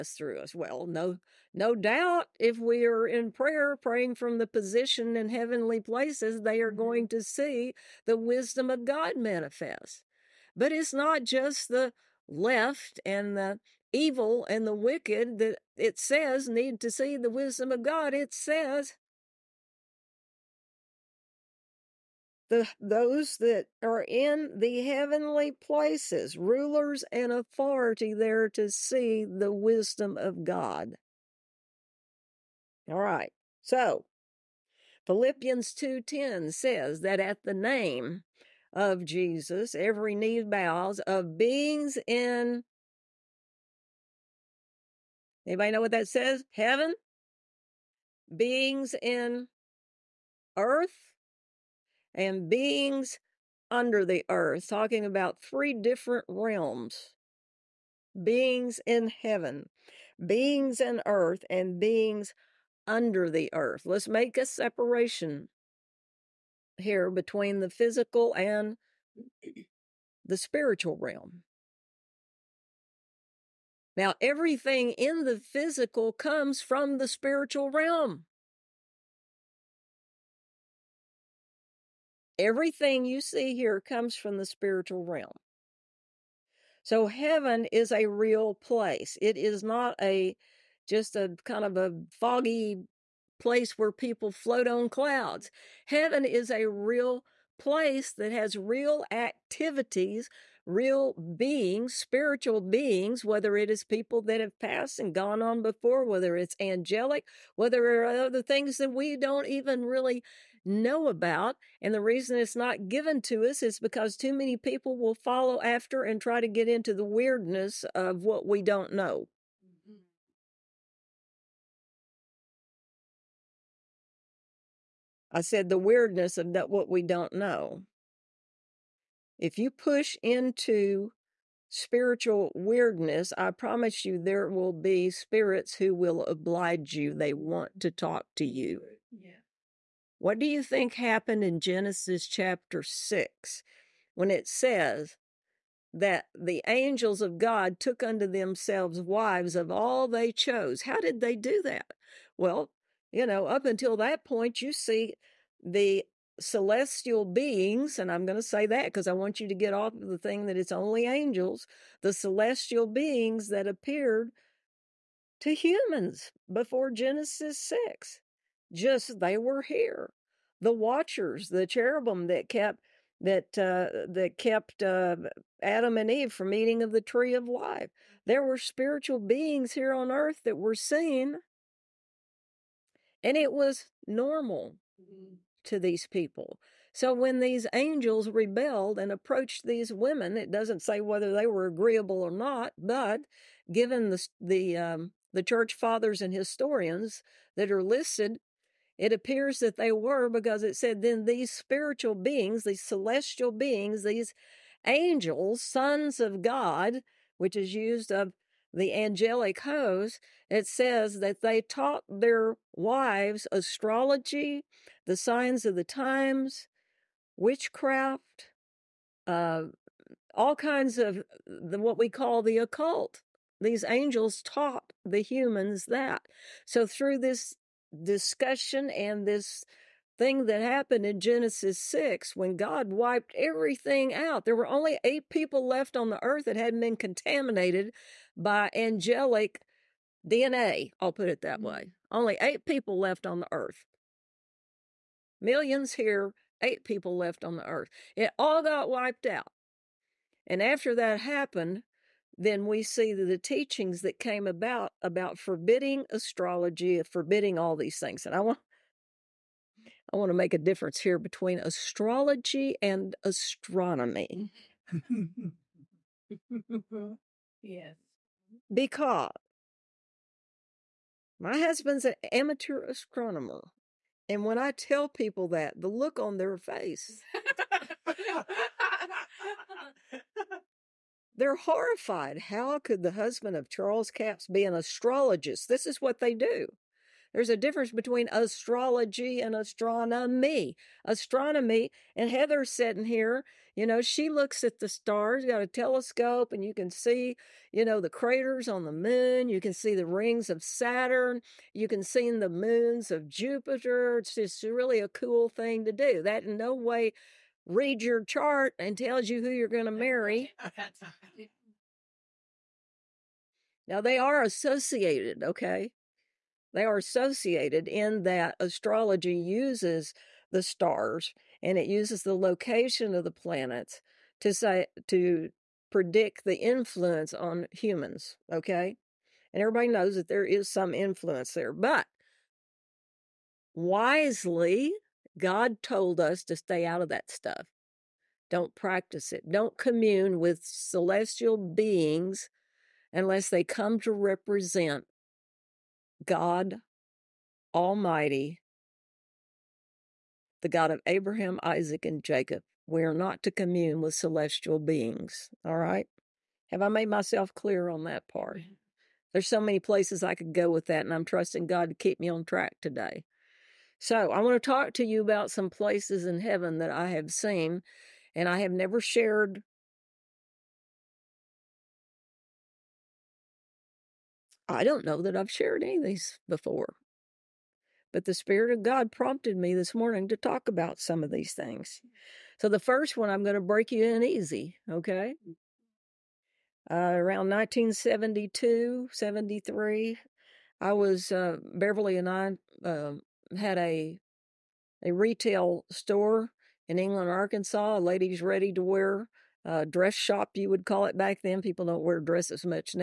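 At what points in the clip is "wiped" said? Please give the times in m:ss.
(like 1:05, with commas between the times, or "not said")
3:52, 4:08.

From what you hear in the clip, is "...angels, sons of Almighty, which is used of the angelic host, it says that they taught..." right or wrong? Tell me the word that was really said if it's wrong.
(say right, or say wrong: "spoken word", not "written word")
wrong: "God", not "Almighty".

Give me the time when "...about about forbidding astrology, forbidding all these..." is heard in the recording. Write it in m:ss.
4:14.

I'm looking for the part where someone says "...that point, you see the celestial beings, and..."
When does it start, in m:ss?
2:33.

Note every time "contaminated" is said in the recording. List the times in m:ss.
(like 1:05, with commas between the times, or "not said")
3:56.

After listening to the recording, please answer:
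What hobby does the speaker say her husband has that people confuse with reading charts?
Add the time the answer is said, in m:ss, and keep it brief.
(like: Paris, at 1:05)
amateur astronomer, at 4:32.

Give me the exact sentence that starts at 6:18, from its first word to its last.
But the Spirit of God prompted me this morning to talk about some of these things.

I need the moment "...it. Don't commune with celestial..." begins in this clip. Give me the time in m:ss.
5:39.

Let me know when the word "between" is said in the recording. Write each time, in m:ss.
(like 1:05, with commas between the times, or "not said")
1:07, 4:21, 4:47.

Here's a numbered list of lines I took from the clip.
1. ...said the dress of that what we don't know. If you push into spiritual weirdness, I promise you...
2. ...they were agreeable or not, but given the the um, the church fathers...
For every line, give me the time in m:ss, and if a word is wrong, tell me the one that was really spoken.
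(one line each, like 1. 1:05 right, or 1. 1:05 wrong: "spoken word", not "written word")
1. 2:05 wrong: "weirdness", not "dress"
2. 3:11 right.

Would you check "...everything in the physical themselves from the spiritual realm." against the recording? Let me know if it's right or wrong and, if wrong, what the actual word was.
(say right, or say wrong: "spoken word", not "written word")
wrong: "comes", not "themselves".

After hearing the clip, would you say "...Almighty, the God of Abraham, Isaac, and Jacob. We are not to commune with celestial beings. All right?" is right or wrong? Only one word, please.
right.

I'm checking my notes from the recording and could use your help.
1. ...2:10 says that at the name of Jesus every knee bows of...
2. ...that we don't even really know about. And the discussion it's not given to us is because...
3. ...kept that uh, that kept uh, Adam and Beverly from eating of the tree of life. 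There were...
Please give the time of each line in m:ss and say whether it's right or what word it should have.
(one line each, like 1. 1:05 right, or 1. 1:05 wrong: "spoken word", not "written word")
1. 0:35 right
2. 1:48 wrong: "reason", not "discussion"
3. 2:52 wrong: "Eve", not "Beverly".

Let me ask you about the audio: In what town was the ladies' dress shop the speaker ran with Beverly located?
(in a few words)
England, Arkansas.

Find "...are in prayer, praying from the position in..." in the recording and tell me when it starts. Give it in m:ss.
0:02.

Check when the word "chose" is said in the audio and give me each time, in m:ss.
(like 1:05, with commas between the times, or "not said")
2:30.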